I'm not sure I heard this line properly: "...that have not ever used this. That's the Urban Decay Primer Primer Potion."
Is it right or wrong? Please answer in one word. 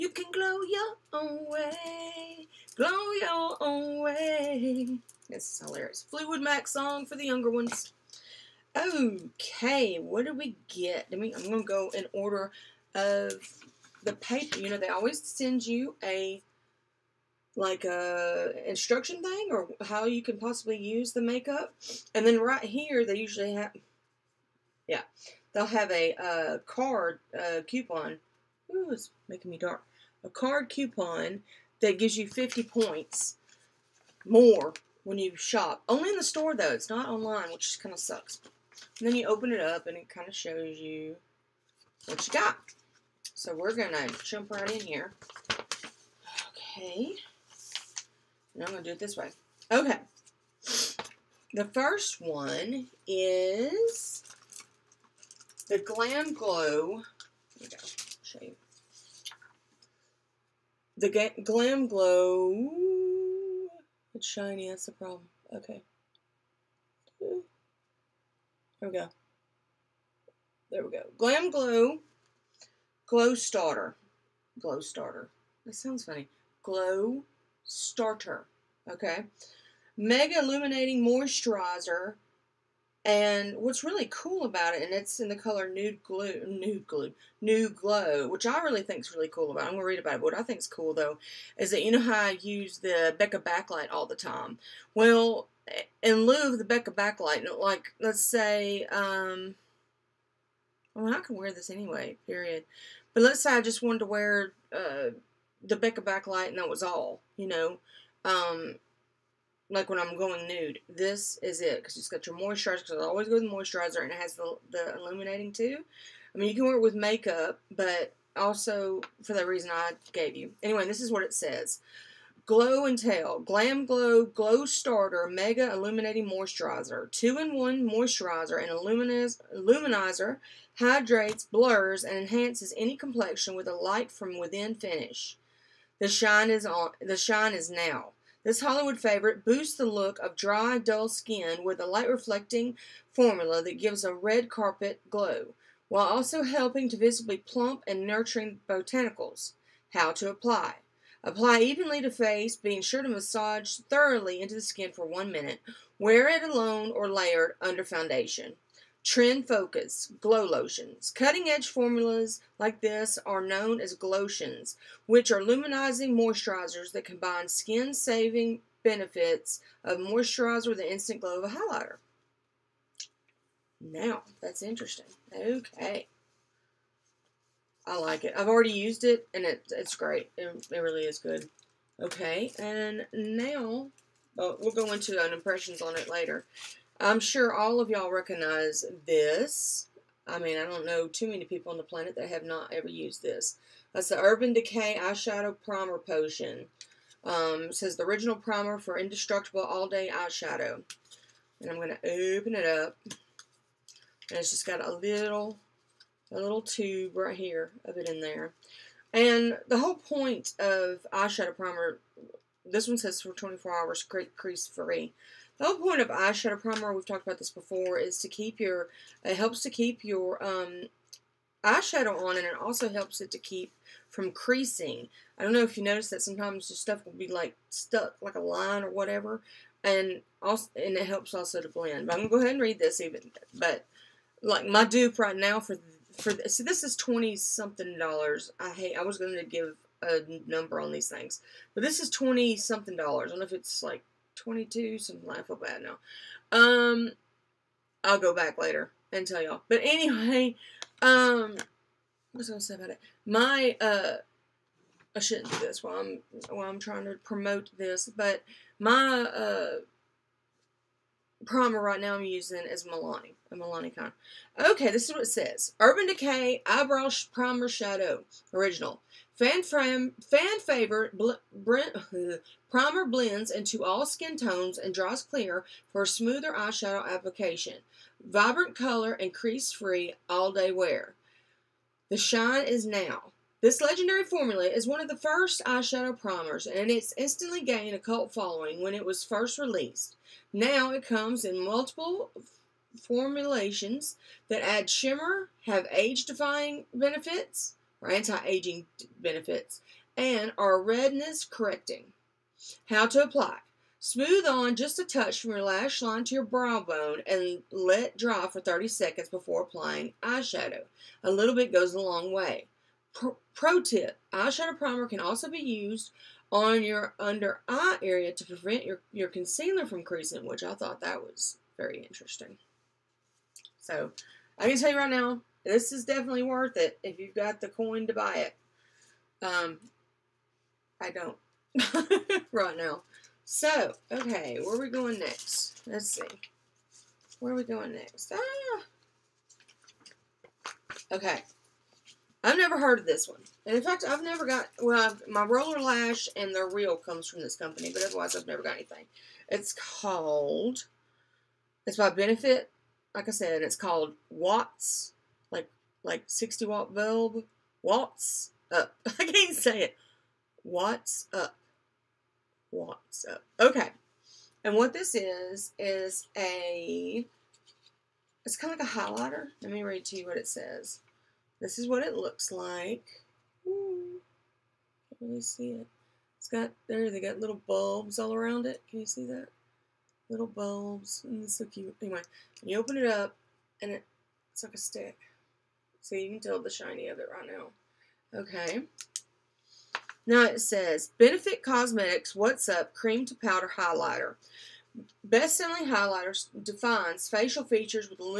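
wrong.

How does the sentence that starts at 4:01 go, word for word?
But this is 20 something dollars.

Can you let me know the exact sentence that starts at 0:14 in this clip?
You know, they always send you a like a instruction thing or how you can possibly use the makeup.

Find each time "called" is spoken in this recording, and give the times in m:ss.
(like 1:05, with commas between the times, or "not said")
5:49, 5:53.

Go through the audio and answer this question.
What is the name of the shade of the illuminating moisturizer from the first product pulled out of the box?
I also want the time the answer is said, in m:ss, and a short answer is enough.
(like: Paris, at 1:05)
Nude Glow, at 1:27.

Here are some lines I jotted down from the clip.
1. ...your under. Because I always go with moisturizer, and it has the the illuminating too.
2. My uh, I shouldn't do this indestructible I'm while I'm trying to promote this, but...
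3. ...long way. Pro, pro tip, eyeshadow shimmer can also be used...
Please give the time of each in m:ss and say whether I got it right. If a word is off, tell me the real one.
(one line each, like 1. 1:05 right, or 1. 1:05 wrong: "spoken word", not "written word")
1. 1:52 wrong: "moisturizer", not "under"
2. 4:13 wrong: "while", not "indestructible"
3. 5:11 wrong: "primer", not "shimmer".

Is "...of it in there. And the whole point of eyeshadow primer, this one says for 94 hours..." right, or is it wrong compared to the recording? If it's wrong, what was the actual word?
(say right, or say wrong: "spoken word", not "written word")
wrong: "24", not "94".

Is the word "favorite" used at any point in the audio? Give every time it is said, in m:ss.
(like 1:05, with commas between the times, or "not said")
2:18, 4:30.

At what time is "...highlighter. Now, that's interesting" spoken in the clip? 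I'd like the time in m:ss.
2:51.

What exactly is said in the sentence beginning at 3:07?
I'm sure all of y'all recognize this.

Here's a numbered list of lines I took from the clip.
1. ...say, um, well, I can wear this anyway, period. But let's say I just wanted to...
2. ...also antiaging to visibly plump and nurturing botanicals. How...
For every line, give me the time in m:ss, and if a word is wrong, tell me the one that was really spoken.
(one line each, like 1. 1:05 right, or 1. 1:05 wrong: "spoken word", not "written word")
1. 1:38 right
2. 2:26 wrong: "helping", not "antiaging".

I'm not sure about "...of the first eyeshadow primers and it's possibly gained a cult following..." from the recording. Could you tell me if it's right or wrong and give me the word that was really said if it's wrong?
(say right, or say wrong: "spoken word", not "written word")
wrong: "instantly", not "possibly".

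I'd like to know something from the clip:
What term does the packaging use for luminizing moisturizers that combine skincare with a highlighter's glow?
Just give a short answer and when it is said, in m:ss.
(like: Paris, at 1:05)
glotions, at 2:43.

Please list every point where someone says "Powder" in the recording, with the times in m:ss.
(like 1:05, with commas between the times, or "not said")
6:33.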